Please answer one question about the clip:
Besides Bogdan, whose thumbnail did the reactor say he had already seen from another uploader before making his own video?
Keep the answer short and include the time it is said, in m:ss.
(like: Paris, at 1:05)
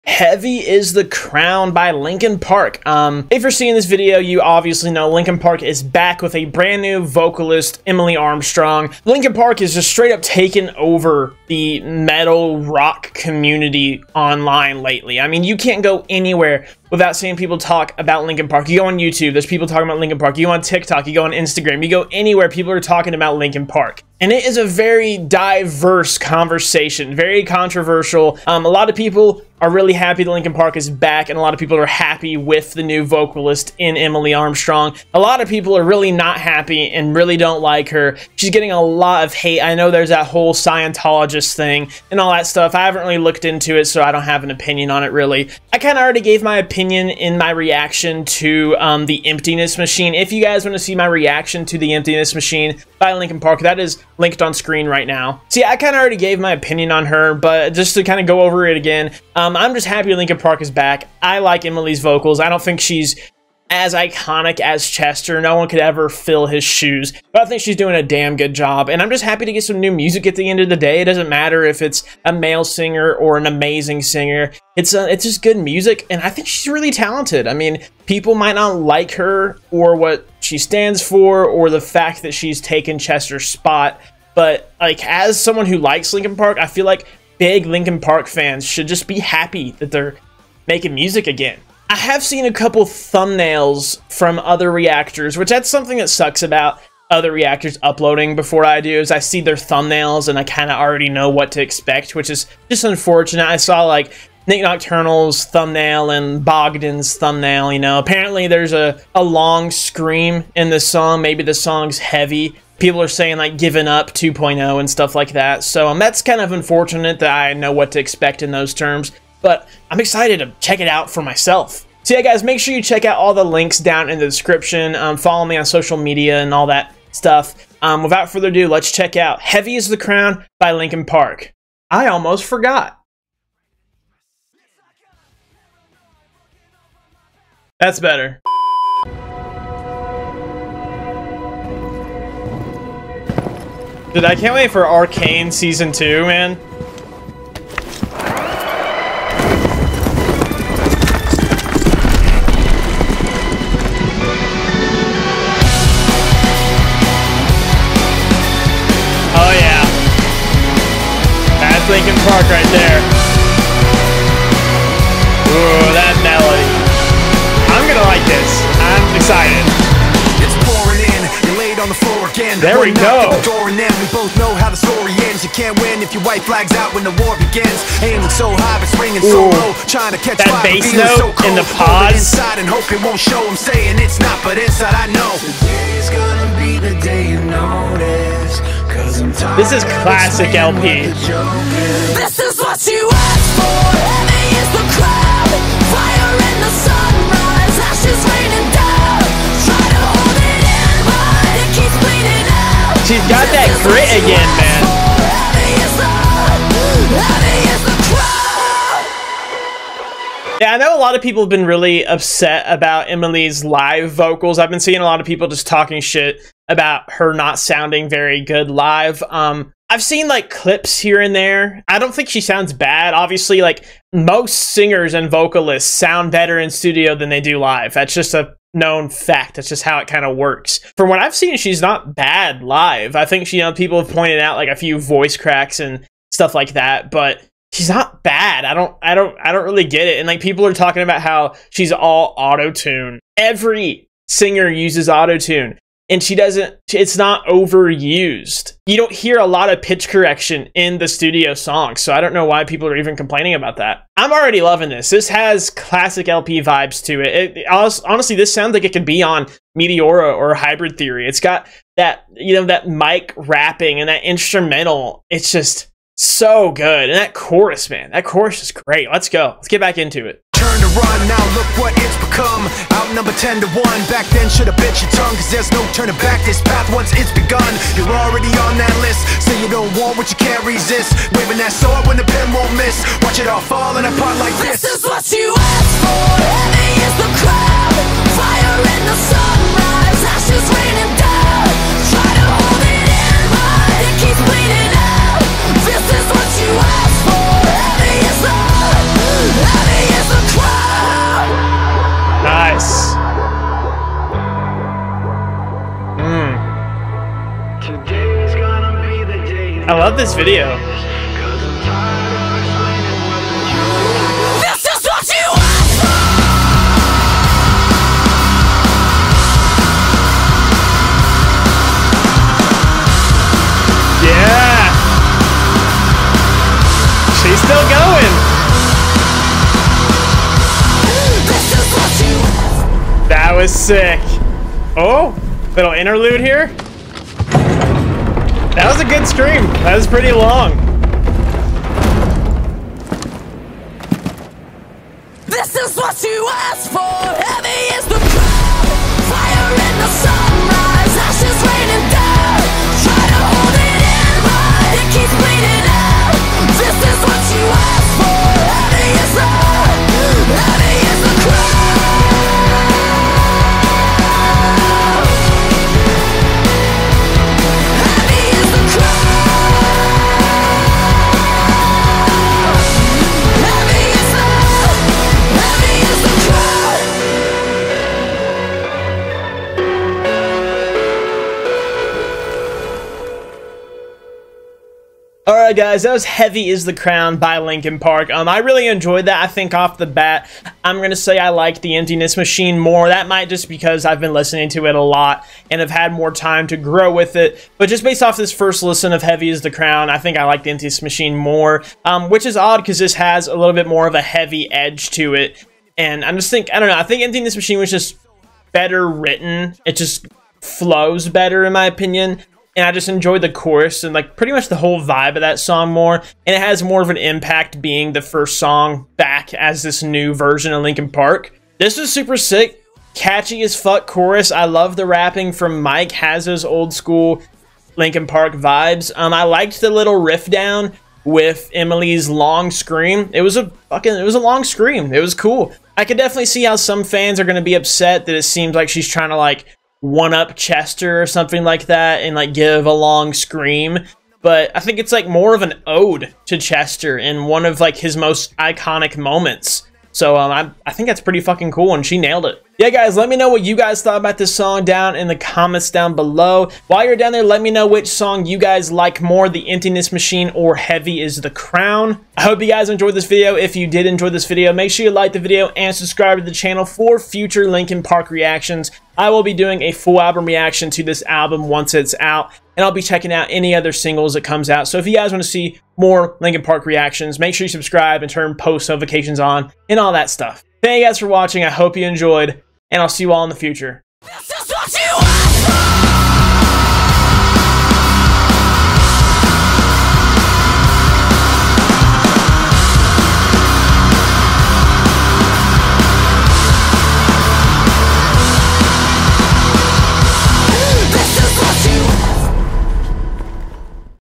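Nick Nocturnal, at 1:44.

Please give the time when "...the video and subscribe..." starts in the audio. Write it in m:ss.
7:45.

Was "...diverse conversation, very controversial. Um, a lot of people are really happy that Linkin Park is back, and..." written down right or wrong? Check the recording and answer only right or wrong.
right.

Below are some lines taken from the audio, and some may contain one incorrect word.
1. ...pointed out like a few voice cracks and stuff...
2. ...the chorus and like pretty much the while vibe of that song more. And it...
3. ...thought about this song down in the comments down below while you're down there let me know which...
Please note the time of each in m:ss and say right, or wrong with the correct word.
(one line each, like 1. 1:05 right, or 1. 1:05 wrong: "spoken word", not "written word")
1. 3:54 right
2. 6:53 wrong: "whole", not "while"
3. 7:34 right.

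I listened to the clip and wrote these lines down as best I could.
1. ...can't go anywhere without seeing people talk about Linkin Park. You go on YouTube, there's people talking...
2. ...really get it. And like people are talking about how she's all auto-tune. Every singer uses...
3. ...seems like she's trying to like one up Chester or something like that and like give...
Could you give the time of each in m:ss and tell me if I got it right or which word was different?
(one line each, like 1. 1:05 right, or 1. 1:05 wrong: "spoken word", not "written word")
1. 0:15 right
2. 3:59 right
3. 7:18 right.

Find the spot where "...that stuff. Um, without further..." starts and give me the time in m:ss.
2:06.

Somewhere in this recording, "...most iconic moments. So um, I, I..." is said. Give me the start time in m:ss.
7:28.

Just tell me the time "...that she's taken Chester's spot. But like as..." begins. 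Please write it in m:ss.
1:22.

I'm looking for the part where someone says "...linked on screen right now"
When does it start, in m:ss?
0:54.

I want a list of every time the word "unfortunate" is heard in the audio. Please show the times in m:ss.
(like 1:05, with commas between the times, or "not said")
1:42, 1:56.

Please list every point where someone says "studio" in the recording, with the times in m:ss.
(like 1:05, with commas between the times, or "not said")
3:46, 4:11.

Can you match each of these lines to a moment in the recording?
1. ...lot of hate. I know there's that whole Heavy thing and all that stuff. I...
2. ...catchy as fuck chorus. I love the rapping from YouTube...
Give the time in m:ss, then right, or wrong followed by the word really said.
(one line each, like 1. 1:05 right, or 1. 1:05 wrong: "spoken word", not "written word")
1. 0:38 wrong: "Scientologist", not "Heavy"
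2. 7:03 wrong: "Mike", not "YouTube".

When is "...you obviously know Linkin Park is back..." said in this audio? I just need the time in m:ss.
0:04.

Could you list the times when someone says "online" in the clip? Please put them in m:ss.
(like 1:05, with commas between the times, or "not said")
0:14.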